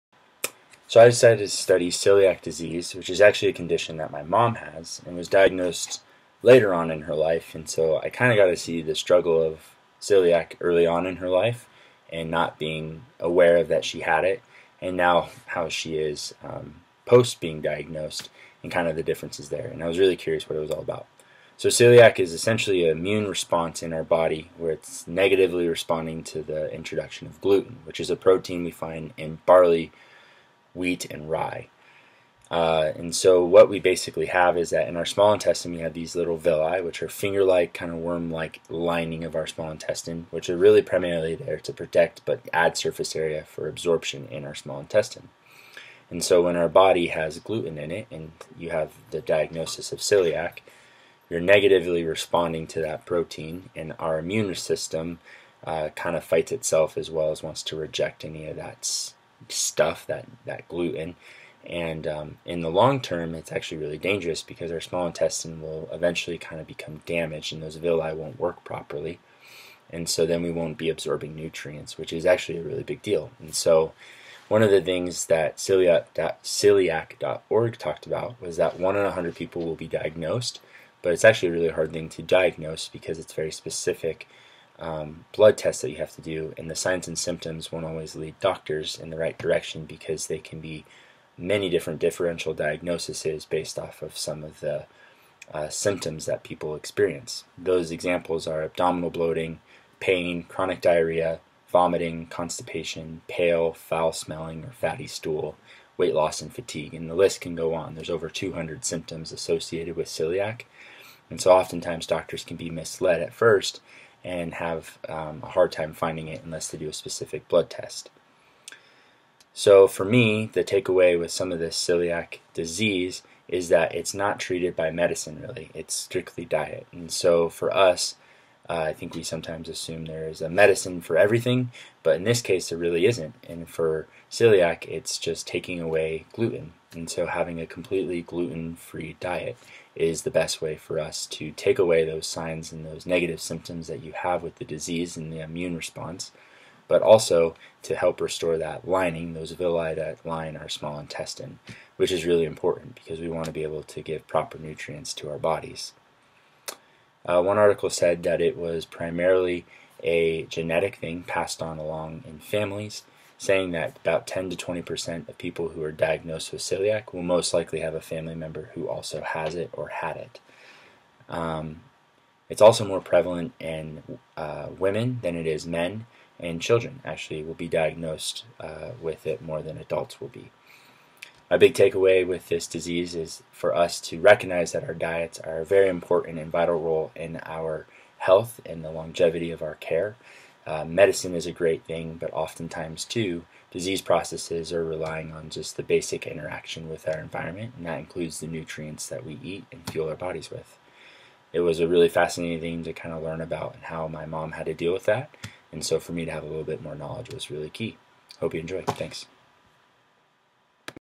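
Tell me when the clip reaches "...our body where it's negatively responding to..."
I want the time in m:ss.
0:23.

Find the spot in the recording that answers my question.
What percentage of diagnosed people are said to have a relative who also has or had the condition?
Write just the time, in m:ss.
2:44.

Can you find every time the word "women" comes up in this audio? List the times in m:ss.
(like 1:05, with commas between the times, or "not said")
2:54.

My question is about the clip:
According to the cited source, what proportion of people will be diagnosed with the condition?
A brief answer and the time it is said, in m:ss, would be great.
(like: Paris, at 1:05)
1 in 100, at 1:18.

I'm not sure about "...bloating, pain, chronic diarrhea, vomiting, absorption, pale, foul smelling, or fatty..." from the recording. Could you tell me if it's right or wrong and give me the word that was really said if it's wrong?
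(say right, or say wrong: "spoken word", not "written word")
wrong: "constipation", not "absorption".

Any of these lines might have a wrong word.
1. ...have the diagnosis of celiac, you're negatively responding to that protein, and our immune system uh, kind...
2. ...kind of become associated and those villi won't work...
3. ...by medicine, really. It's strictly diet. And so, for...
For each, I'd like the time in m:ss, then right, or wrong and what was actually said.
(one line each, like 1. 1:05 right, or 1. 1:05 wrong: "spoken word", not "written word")
1. 0:48 right
2. 1:06 wrong: "damaged", not "associated"
3. 2:04 right.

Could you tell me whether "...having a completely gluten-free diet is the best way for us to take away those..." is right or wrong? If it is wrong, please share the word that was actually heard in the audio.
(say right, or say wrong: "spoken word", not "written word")
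right.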